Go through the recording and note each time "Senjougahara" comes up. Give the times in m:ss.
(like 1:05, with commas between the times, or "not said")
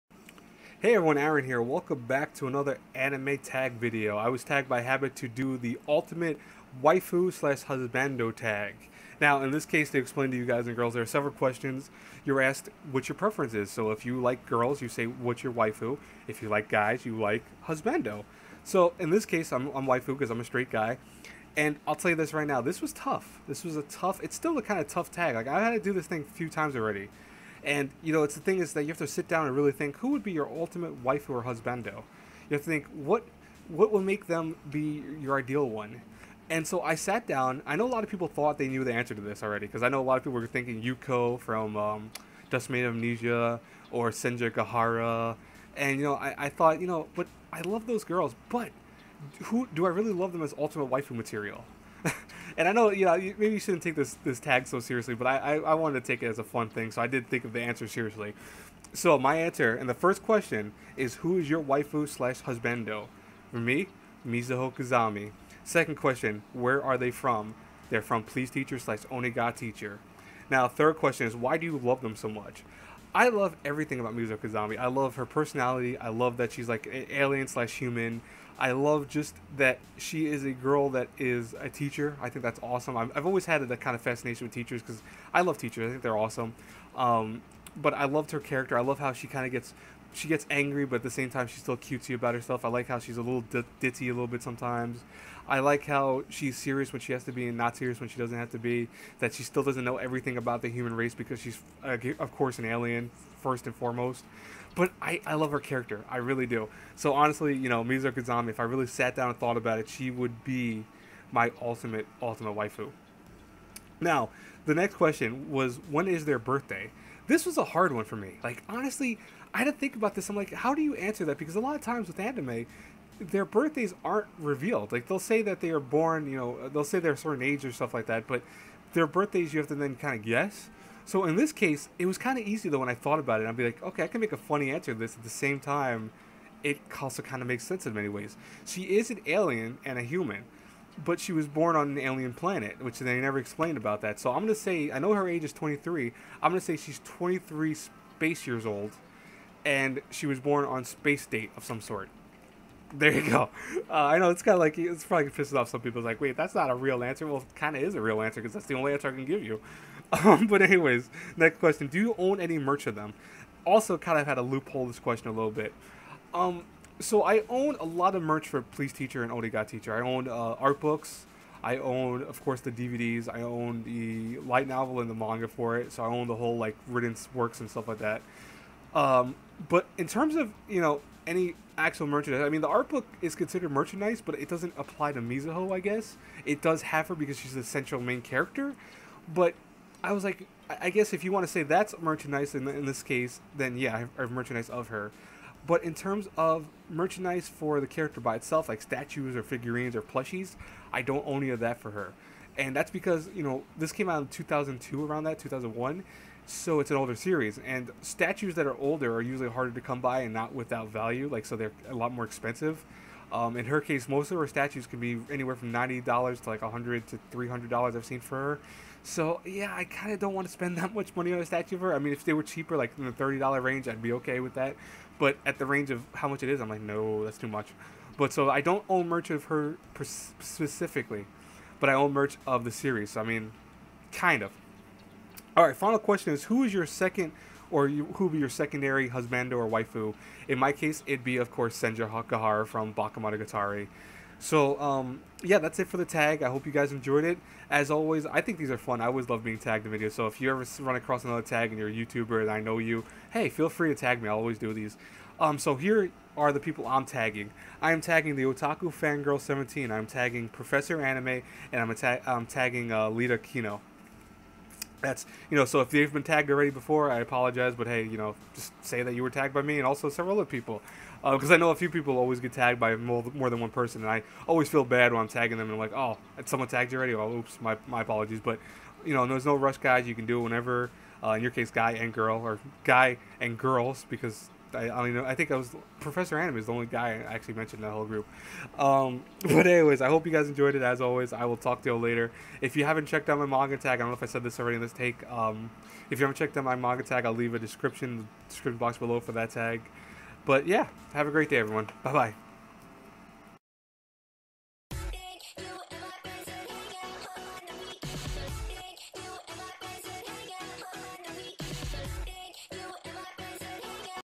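0:44, 4:01.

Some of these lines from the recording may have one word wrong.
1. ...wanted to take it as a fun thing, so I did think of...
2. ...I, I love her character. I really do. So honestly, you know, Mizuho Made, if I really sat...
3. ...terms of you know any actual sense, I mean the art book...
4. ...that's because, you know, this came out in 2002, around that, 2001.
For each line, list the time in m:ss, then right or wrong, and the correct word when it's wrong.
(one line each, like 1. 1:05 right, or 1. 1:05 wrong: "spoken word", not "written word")
1. 0:55 right
2. 1:45 wrong: "Kazami", not "Made"
3. 3:00 wrong: "merchandise", not "sense"
4. 3:22 right.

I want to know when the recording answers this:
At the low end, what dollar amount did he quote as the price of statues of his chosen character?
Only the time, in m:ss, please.
3:35.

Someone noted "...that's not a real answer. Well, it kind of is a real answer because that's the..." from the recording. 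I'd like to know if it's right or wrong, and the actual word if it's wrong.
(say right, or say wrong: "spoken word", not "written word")
right.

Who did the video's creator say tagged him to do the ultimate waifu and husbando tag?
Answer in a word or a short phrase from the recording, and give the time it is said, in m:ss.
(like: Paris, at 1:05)
Habit, at 0:04.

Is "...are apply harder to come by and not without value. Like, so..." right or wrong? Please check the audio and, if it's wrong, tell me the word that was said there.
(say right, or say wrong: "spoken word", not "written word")
wrong: "usually", not "apply".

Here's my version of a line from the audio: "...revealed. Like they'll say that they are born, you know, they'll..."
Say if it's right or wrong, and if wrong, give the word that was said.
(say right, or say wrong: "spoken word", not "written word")
right.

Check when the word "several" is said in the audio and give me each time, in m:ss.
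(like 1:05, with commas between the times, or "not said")
0:11, 4:30.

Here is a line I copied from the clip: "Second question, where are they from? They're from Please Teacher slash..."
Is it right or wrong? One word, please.
right.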